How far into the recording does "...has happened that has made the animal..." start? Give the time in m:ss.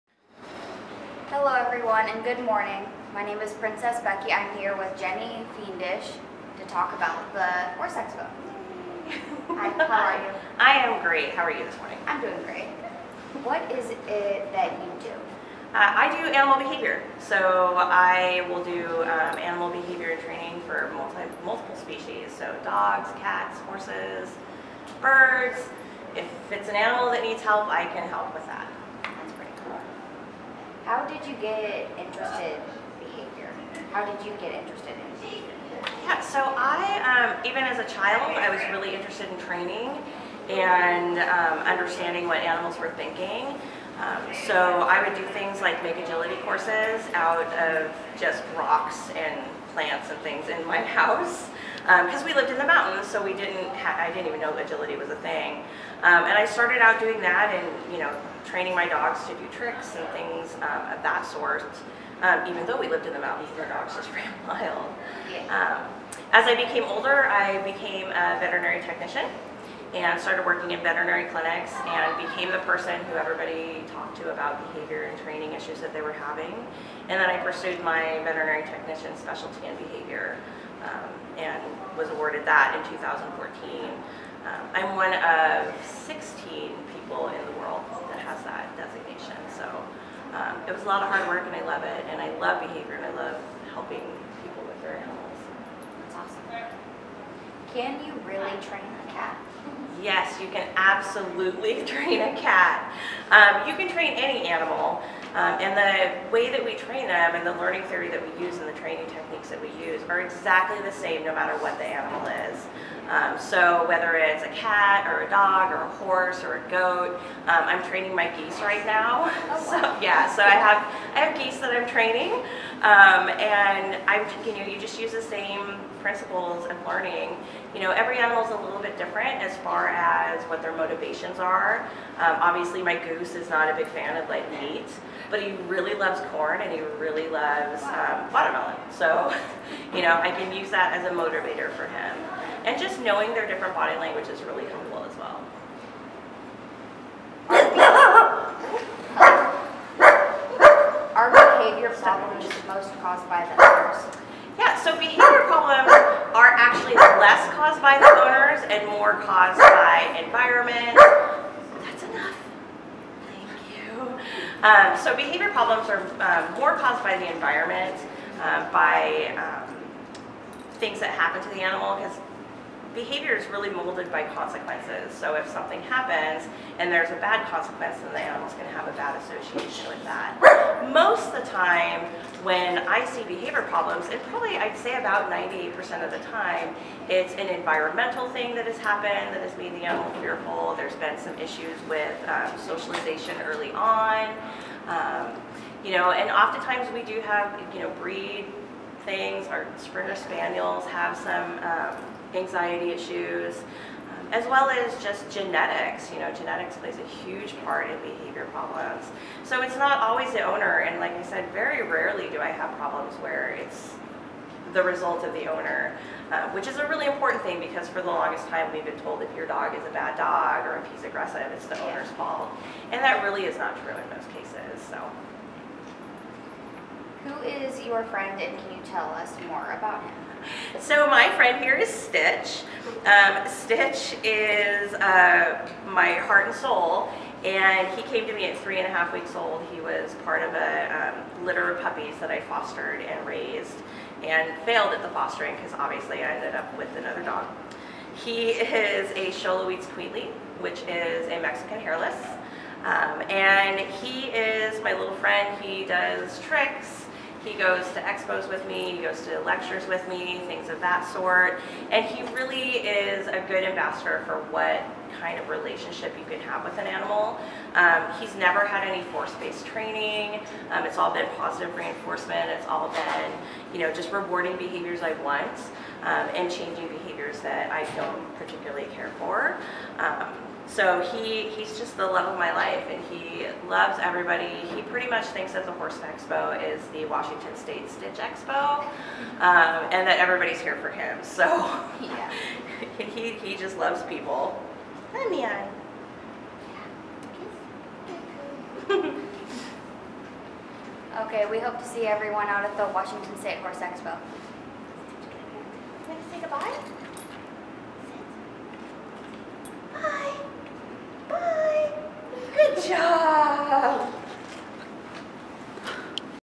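3:08.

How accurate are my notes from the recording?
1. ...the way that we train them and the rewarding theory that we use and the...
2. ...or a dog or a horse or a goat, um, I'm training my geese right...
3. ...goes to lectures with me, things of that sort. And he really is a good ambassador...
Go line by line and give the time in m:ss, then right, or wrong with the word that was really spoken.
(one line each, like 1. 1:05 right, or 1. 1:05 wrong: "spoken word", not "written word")
1. 1:45 wrong: "learning", not "rewarding"
2. 1:55 right
3. 4:19 right.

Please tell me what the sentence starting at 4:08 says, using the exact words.
He is a Xoloitzcuintli, which is a Mexican hairless.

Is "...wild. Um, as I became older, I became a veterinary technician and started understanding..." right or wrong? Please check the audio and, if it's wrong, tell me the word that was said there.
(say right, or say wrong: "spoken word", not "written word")
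wrong: "working", not "understanding".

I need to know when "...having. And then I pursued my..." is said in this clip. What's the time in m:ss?
1:16.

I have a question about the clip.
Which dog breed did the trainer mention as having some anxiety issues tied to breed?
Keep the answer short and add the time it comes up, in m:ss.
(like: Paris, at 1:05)
Springer Spaniels, at 3:19.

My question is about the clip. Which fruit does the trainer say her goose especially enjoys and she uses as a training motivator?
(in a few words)
Watermelon.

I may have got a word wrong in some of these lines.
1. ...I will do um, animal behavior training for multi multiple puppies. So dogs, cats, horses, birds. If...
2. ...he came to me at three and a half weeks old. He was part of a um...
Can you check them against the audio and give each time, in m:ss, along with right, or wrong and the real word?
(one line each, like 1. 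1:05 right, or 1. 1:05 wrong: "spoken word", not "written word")
1. 0:17 wrong: "species", not "puppies"
2. 3:57 right.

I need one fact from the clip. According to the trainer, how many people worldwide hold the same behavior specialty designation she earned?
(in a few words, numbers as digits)
16.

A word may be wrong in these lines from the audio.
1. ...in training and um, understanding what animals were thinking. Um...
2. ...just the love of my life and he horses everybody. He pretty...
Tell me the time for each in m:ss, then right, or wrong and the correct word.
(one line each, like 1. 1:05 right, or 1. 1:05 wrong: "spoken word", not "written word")
1. 0:39 right
2. 4:41 wrong: "loves", not "horses".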